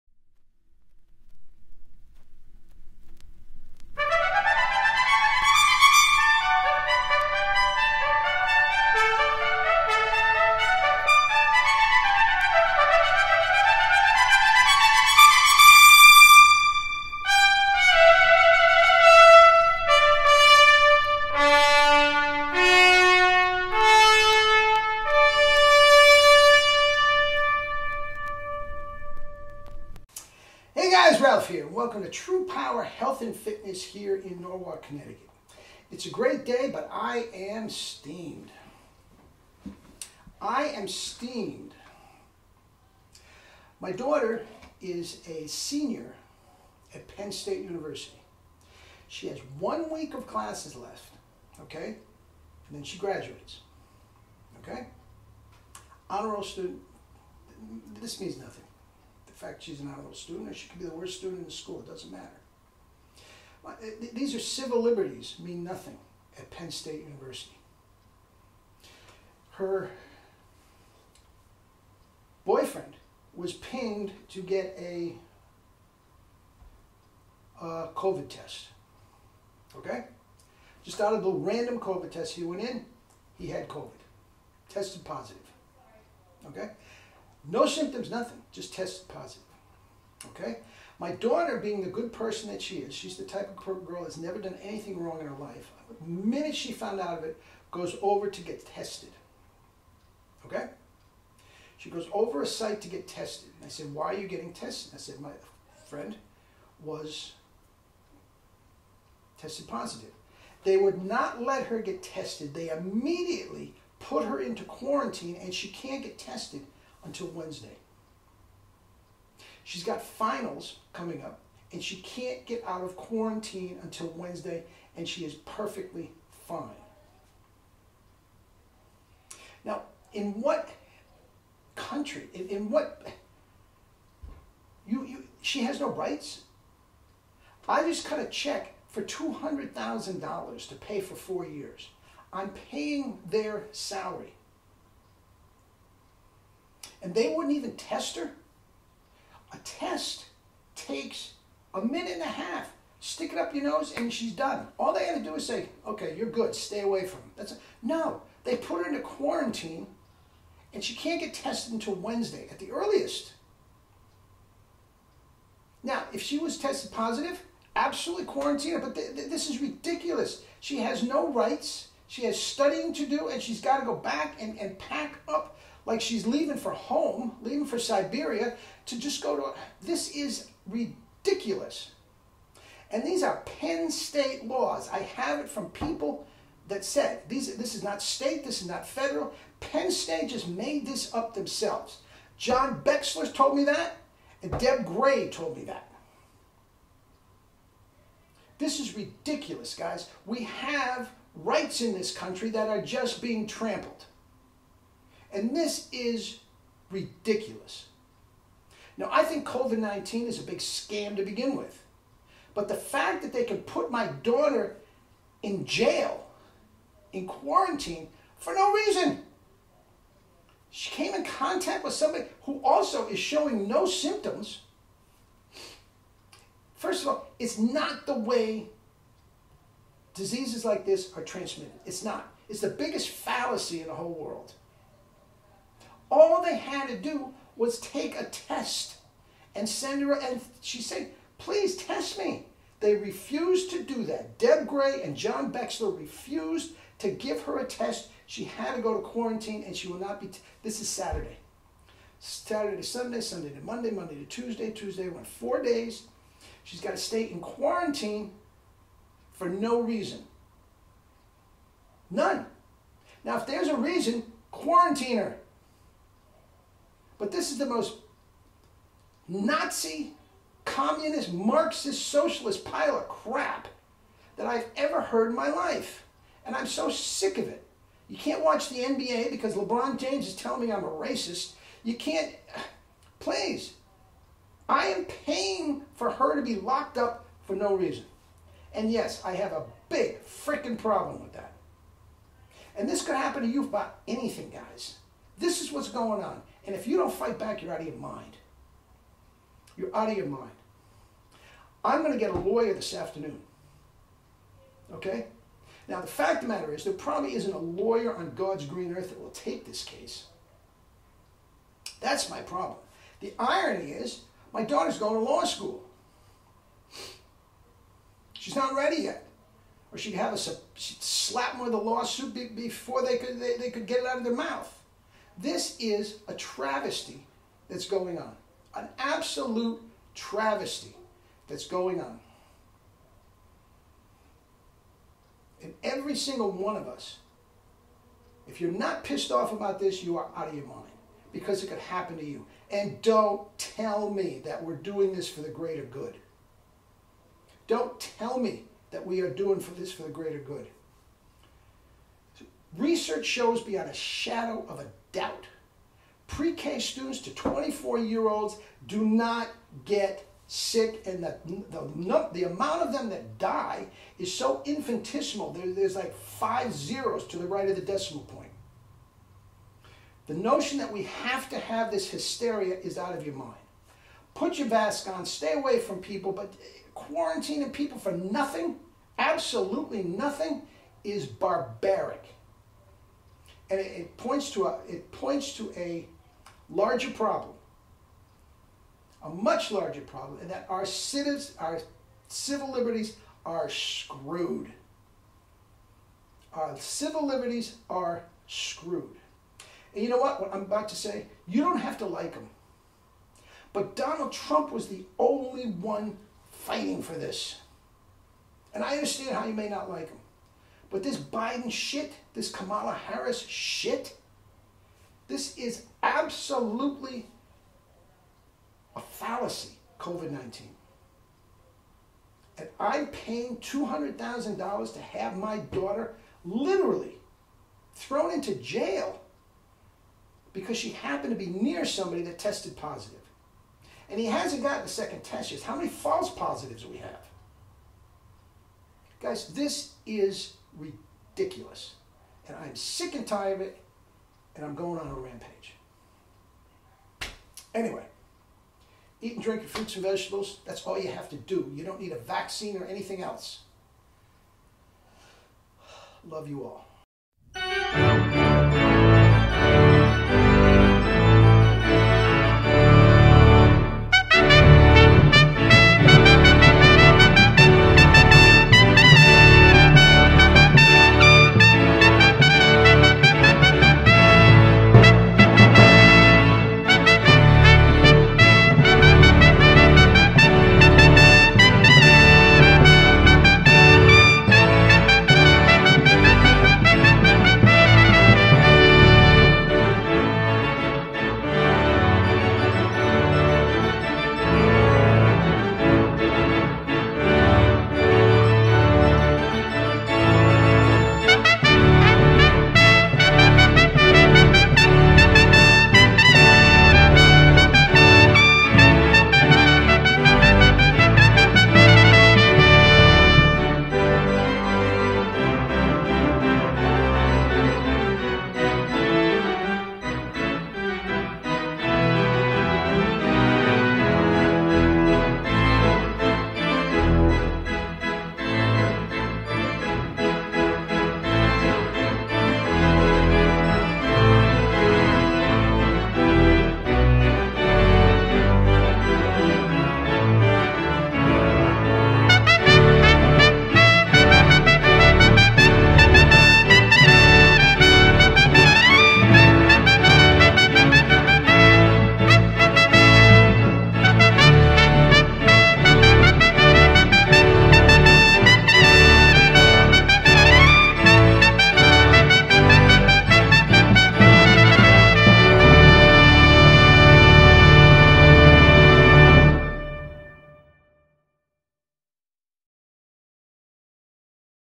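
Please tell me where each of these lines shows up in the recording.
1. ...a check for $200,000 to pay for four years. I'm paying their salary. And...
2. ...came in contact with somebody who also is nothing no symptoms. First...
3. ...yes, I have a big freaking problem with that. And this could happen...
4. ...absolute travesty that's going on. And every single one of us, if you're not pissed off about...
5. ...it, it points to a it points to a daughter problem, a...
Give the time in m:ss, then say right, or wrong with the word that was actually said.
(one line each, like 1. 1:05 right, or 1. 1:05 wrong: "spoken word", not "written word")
1. 2:18 right
2. 3:40 wrong: "showing", not "nothing"
3. 4:48 right
4. 5:28 right
5. 6:23 wrong: "larger", not "daughter".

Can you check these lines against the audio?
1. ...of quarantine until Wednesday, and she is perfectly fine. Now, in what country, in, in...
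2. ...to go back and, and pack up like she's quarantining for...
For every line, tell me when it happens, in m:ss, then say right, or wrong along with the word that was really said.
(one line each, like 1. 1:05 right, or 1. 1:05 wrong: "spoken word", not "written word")
1. 2:02 right
2. 2:53 wrong: "leaving", not "quarantining".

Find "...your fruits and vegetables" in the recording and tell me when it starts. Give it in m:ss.
7:29.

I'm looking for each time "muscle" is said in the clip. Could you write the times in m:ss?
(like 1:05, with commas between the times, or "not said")
not said.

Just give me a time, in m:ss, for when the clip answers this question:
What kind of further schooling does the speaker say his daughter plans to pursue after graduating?
5:15.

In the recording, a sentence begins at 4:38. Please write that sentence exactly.
You can't watch the NBA because LeBron James is telling me I'm a racist.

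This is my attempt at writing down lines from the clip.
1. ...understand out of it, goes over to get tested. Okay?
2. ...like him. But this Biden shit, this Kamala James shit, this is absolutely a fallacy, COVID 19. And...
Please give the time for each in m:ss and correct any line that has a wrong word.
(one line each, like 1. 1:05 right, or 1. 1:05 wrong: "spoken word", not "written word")
1. 1:36 wrong: "found", not "understand"
2. 6:49 wrong: "Harris", not "James".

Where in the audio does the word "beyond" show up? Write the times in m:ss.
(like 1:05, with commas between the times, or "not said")
5:53.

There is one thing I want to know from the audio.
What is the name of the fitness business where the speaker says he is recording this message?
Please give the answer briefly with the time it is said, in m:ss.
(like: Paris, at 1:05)
True Power Health and Fitness, at 0:32.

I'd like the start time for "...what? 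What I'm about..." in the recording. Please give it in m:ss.
6:40.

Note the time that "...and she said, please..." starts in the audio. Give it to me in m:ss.
4:00.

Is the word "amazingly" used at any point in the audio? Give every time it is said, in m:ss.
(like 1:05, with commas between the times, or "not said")
not said.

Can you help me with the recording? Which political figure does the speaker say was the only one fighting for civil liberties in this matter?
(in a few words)
Donald Trump.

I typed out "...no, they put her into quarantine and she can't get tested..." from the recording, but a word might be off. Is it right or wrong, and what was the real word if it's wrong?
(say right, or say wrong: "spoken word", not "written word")
right.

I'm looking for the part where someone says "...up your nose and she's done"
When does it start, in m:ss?
2:33.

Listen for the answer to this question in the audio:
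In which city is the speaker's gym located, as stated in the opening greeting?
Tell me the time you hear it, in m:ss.
0:34.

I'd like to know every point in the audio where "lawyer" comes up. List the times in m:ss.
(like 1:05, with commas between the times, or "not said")
5:02, 5:07.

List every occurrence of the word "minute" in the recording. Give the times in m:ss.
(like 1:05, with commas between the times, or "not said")
1:36, 2:31.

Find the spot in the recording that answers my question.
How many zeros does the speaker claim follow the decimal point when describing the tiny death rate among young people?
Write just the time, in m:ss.
6:06.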